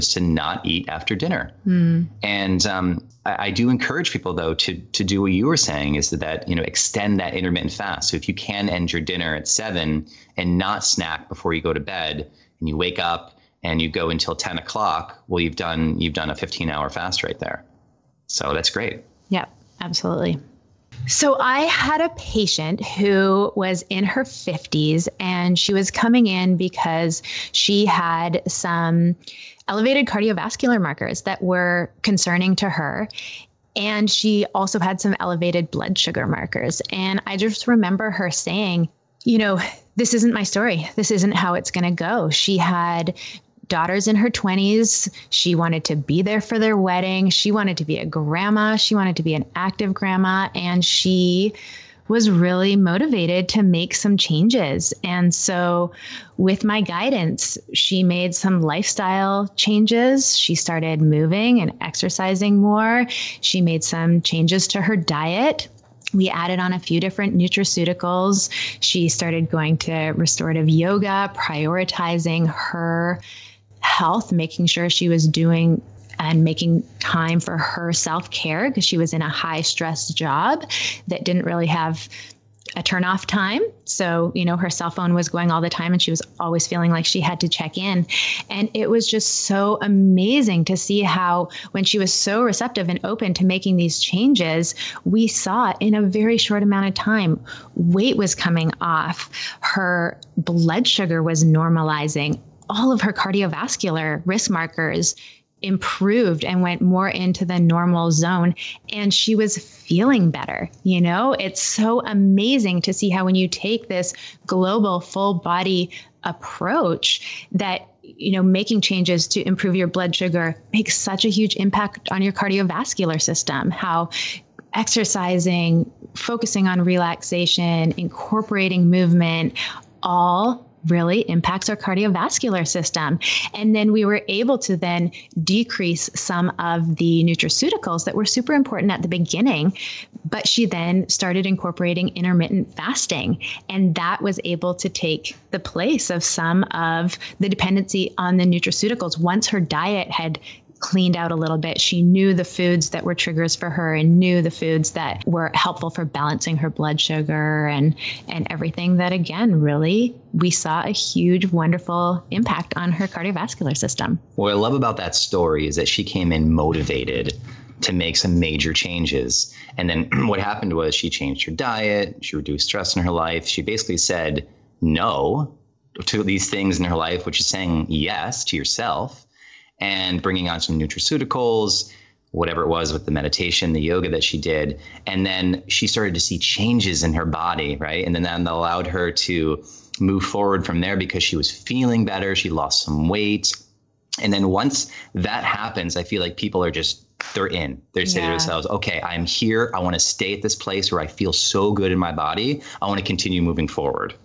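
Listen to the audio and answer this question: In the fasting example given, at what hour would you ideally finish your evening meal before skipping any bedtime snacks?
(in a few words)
7.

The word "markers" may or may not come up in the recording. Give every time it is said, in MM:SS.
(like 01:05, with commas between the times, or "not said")
00:30, 00:36, 01:44.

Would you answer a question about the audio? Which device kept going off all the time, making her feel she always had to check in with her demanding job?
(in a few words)
cell phone.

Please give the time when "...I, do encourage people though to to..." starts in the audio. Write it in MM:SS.
00:03.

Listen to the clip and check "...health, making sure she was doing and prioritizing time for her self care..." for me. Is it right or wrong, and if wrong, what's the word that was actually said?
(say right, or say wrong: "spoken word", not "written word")
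wrong: "making", not "prioritizing".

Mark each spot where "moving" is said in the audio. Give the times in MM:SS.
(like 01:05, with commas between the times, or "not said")
01:00, 03:23.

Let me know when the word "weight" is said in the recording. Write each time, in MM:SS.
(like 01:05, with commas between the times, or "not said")
01:37, 03:13.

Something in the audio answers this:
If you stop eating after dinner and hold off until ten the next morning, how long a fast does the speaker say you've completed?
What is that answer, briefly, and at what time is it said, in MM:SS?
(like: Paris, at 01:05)
15 hours, at 00:16.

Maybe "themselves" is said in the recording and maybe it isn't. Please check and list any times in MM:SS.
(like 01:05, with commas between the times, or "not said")
03:18.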